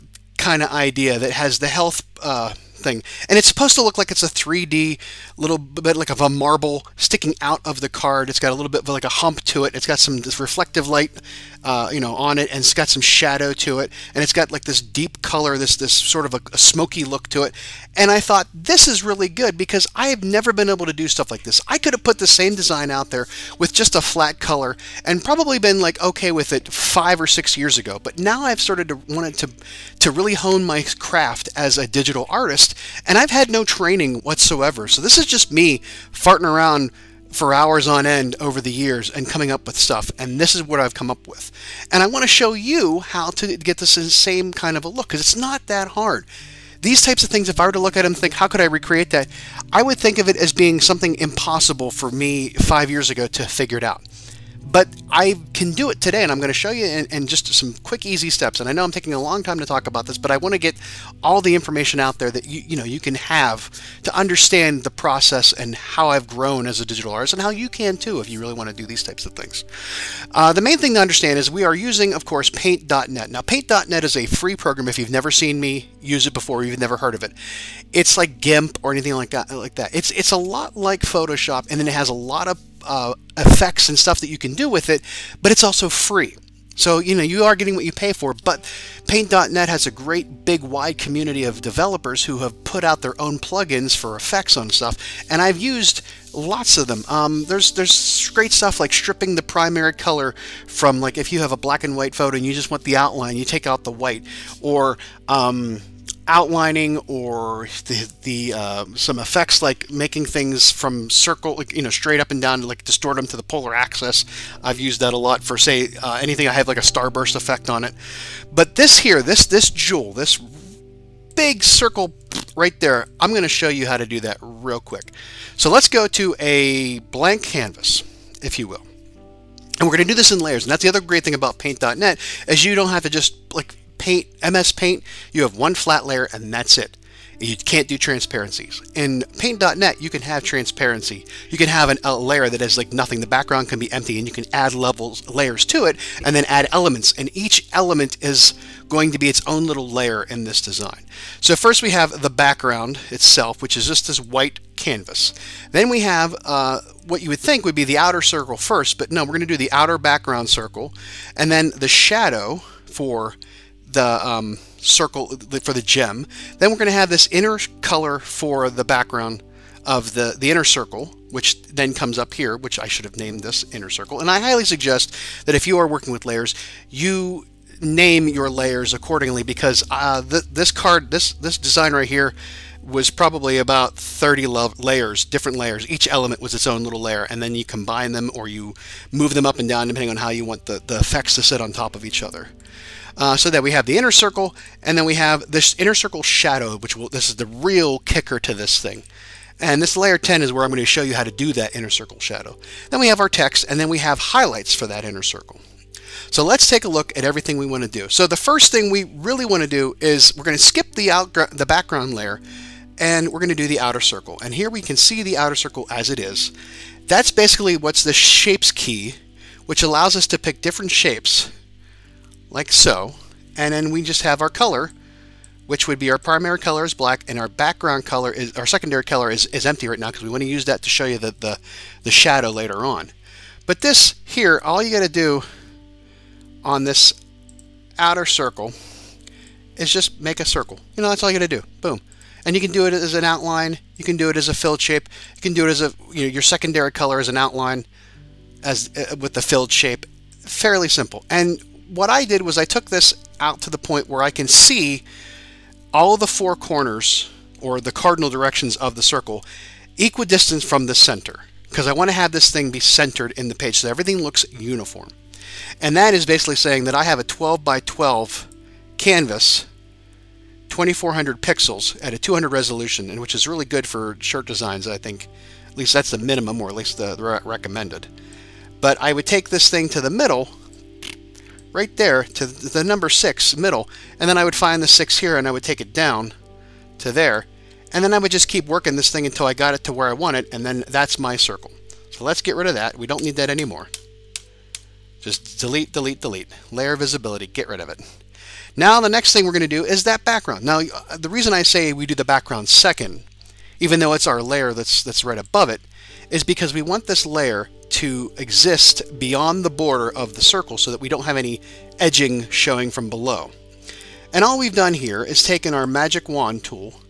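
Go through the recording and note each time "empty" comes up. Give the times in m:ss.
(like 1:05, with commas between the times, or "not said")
2:23, 3:49.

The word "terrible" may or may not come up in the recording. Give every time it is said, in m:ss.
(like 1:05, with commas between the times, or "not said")
not said.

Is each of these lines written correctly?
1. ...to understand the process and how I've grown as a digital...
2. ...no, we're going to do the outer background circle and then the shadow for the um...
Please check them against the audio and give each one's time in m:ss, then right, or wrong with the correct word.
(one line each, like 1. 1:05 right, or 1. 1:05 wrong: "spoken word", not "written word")
1. 1:04 right
2. 2:39 right.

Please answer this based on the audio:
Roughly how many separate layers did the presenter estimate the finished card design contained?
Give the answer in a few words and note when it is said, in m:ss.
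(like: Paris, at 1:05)
30, at 3:03.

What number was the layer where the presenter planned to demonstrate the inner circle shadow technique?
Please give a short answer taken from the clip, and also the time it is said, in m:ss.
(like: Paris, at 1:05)
10, at 3:19.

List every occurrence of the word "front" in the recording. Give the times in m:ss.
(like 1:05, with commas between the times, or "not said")
not said.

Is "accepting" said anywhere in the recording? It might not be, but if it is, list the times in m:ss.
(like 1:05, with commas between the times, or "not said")
not said.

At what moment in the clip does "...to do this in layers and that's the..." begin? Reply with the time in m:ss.
2:10.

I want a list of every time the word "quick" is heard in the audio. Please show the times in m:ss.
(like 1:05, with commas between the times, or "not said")
0:57, 2:04.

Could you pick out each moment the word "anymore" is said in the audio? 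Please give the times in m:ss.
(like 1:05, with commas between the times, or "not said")
4:53.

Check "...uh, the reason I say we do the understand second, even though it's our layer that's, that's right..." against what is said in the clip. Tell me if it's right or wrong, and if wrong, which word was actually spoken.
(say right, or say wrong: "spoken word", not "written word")
wrong: "background", not "understand".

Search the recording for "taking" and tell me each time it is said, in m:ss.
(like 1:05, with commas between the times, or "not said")
0:58.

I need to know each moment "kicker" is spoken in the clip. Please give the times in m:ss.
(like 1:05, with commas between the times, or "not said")
3:17.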